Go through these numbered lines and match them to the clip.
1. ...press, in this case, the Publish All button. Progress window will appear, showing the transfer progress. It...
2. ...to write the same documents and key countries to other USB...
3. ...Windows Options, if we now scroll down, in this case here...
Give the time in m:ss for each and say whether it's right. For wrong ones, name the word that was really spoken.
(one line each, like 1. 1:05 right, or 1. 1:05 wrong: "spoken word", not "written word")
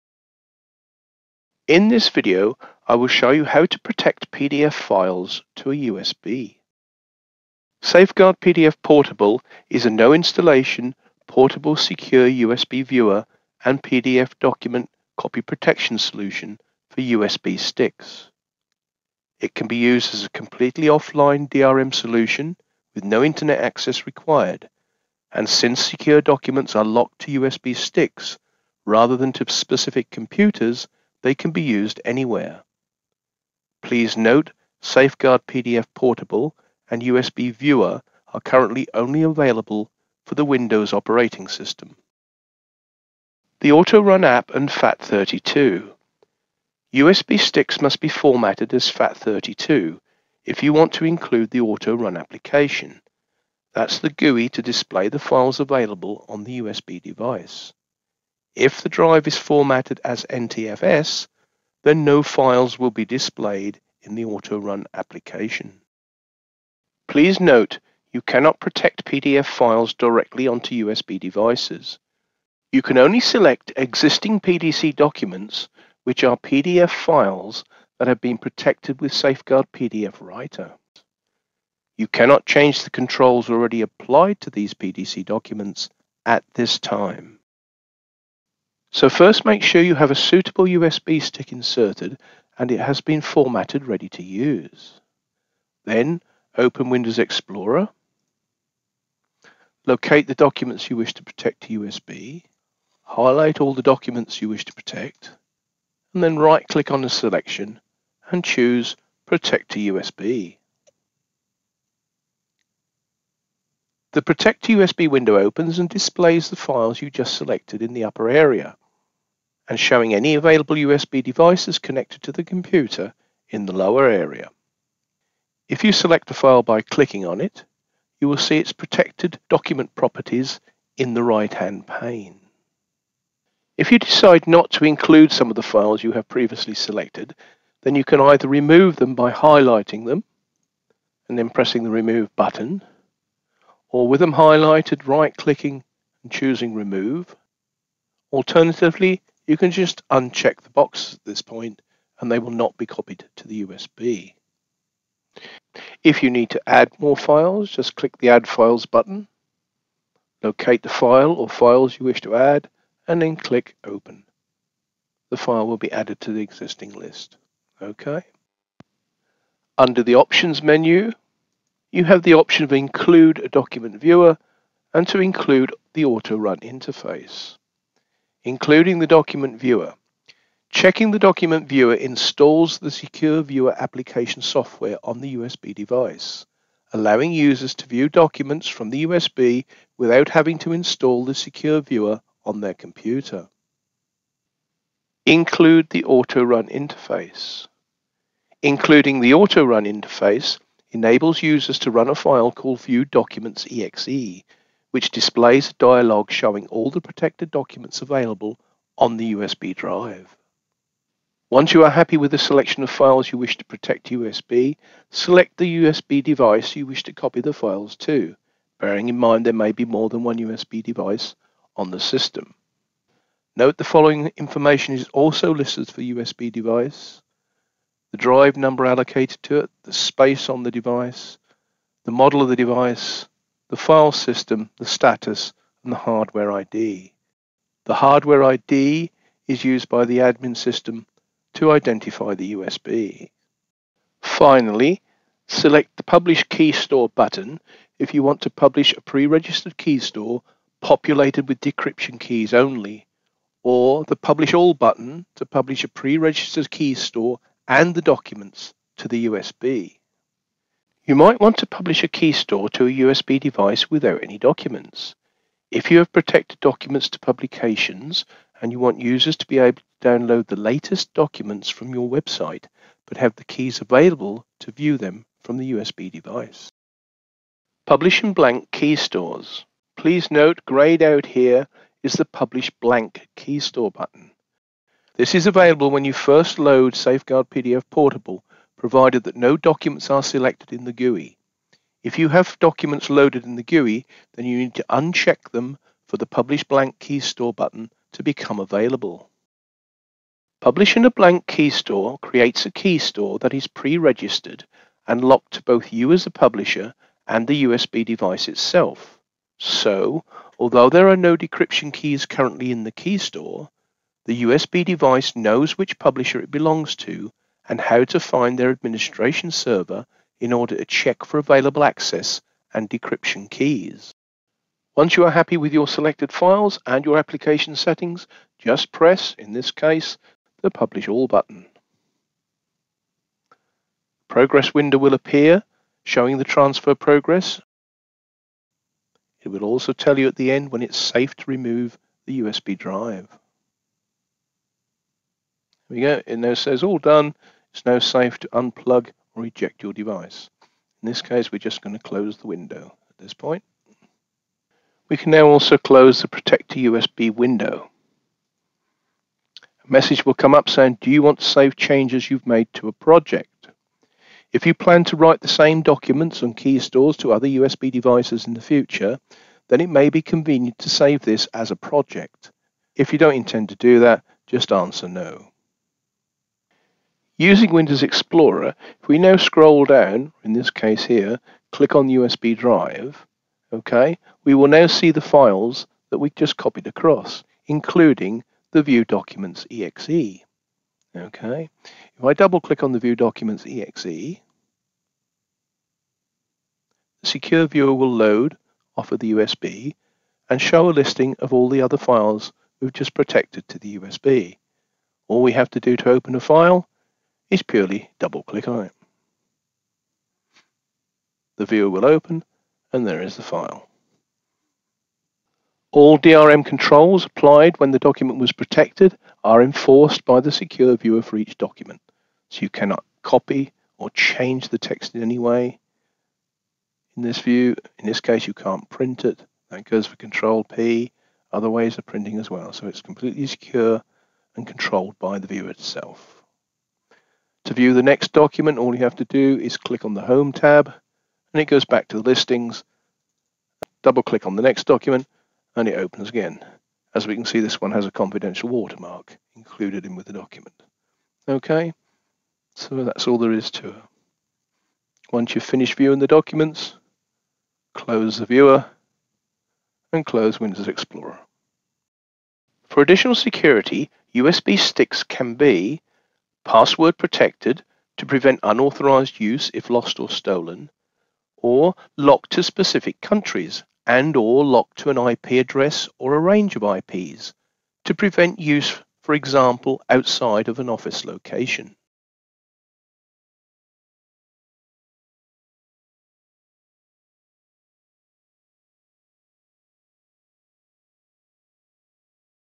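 1. 5:28 right
2. 6:05 wrong: "stores", not "countries"
3. 6:17 wrong: "Explorer", not "Options".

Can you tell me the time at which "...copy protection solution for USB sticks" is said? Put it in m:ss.
0:15.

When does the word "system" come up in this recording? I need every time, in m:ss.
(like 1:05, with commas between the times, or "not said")
0:41, 3:41, 3:54, 4:00.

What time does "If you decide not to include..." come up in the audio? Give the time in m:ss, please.
2:13.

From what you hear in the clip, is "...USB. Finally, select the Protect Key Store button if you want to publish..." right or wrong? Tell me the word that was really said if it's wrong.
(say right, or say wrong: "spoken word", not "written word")
wrong: "Publish", not "Protect".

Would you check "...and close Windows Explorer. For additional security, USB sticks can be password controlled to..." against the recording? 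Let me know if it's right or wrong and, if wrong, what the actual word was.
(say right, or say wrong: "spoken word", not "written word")
wrong: "protected", not "controlled".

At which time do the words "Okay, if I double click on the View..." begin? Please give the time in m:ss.
6:31.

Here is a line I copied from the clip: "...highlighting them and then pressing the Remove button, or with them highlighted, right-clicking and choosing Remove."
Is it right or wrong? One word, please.
right.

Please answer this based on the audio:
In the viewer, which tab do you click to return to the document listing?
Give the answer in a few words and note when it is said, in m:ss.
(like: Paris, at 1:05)
Home tab, at 7:20.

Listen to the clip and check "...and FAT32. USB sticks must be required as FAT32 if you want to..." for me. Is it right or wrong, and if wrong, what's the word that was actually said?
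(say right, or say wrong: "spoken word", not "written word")
wrong: "formatted", not "required".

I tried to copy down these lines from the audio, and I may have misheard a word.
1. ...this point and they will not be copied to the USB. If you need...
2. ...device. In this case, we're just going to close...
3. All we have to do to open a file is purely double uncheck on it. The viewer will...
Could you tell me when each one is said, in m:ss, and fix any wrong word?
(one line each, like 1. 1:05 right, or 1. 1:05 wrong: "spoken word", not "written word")
1. 2:31 right
2. 5:49 right
3. 6:45 wrong: "click", not "uncheck".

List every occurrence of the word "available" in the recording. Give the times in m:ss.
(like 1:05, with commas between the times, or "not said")
0:39, 0:55, 2:00, 3:28, 4:33, 4:45, 4:58, 5:21.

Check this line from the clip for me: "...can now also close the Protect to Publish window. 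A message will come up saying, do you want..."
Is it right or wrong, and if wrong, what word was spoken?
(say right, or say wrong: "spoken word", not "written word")
wrong: "USB", not "Publish".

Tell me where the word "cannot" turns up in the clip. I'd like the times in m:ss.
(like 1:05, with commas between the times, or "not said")
1:08, 1:22, 7:02.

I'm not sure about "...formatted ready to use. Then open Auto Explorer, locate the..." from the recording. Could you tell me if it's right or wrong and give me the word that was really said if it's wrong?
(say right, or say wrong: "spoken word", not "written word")
wrong: "Windows", not "Auto".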